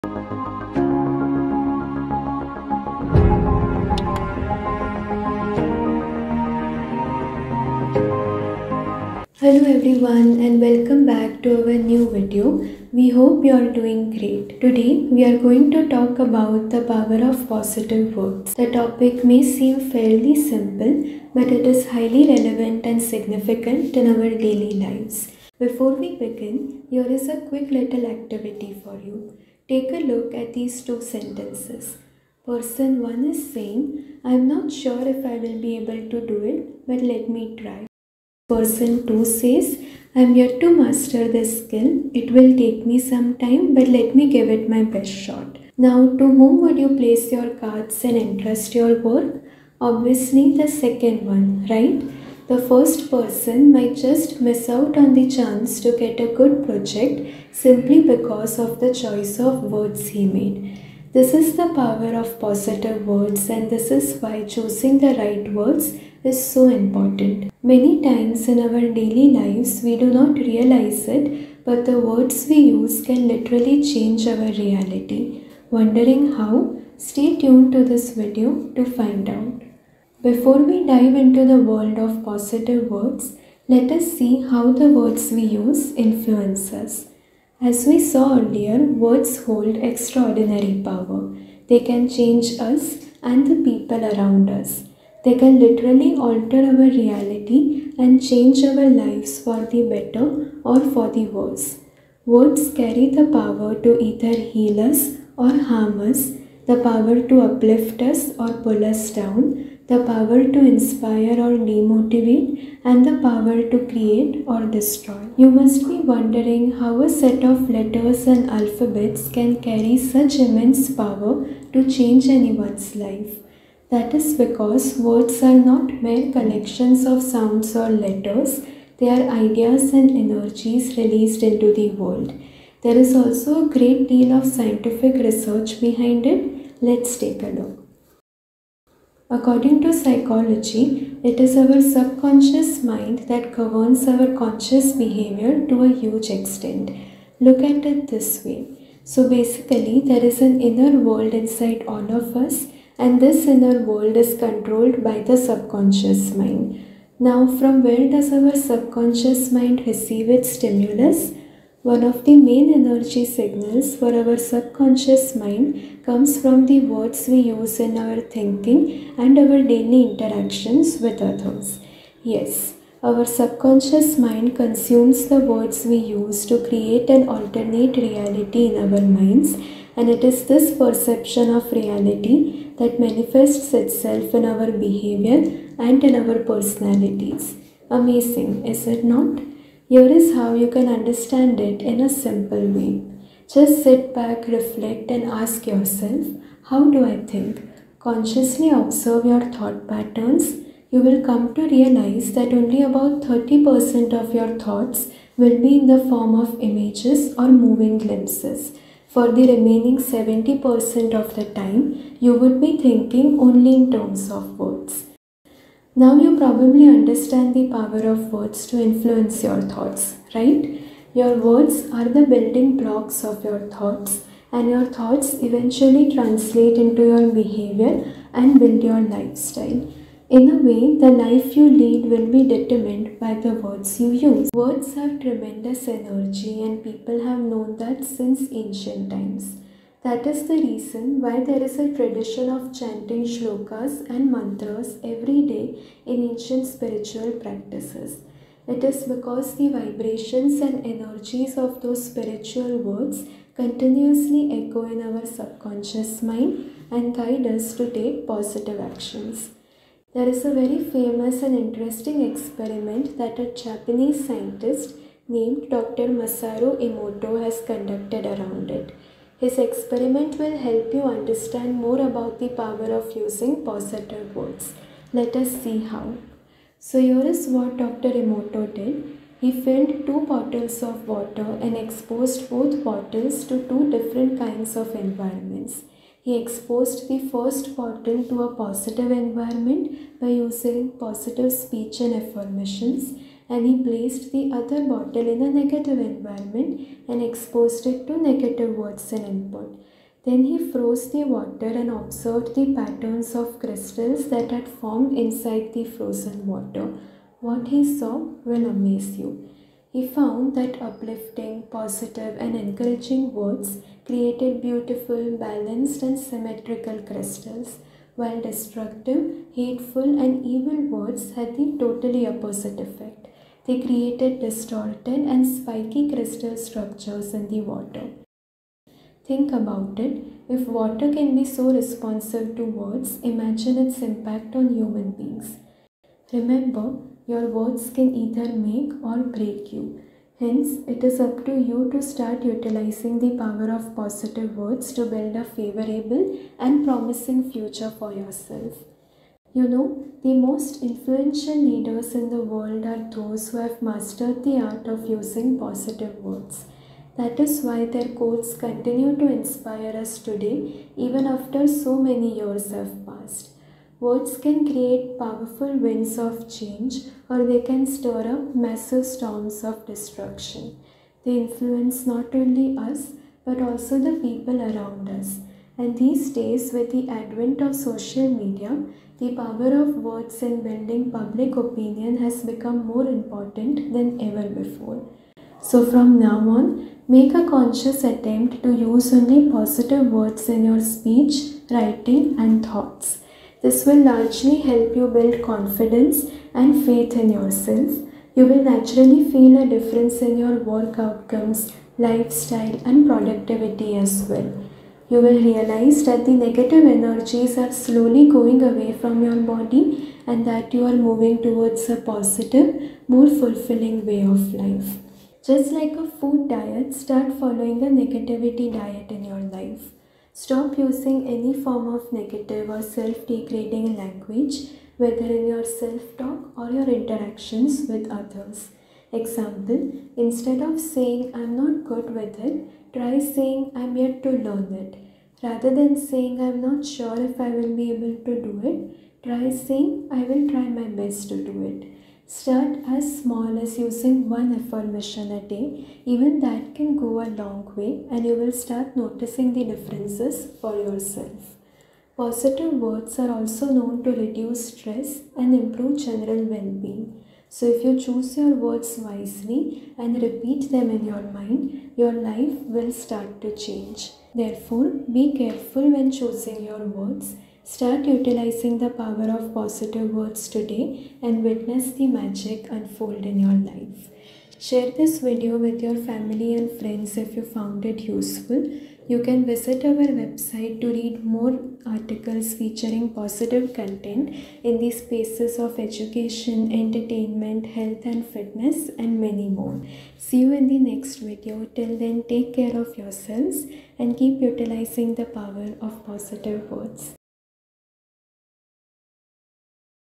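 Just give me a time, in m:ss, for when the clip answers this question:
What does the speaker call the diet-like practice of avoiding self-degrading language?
6:57.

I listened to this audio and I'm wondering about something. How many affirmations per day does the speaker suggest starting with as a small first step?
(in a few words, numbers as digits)
1.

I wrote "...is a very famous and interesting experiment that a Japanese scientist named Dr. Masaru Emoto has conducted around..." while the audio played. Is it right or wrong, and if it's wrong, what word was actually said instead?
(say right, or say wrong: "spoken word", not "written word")
right.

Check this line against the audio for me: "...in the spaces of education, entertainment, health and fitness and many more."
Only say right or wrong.
right.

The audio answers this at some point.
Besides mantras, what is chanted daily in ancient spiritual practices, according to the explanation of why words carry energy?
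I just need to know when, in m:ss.
4:03.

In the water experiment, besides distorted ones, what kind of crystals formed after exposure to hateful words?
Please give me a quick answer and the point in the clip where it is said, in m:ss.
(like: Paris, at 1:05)
spiky, at 5:25.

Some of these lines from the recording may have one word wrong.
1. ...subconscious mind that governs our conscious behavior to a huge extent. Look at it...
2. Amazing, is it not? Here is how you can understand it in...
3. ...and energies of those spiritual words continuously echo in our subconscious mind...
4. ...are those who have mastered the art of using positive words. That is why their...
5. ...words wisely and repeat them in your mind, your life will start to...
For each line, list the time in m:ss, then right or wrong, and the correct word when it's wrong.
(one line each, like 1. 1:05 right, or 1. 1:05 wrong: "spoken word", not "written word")
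1. 2:21 right
2. 3:07 right
3. 4:10 right
4. 5:52 right
5. 7:38 right.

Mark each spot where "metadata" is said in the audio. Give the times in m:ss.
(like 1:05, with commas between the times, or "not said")
not said.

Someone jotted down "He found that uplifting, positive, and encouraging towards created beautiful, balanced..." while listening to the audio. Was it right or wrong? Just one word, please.
wrong.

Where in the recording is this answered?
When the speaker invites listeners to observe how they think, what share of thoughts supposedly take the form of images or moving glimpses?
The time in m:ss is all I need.
3:23.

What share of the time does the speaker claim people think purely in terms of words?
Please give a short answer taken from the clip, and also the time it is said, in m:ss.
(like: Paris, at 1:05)
70%, at 3:29.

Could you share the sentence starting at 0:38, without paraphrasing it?
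Person 2 says, I am yet to master this skill.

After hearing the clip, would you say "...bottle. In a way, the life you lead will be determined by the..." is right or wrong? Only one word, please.
wrong.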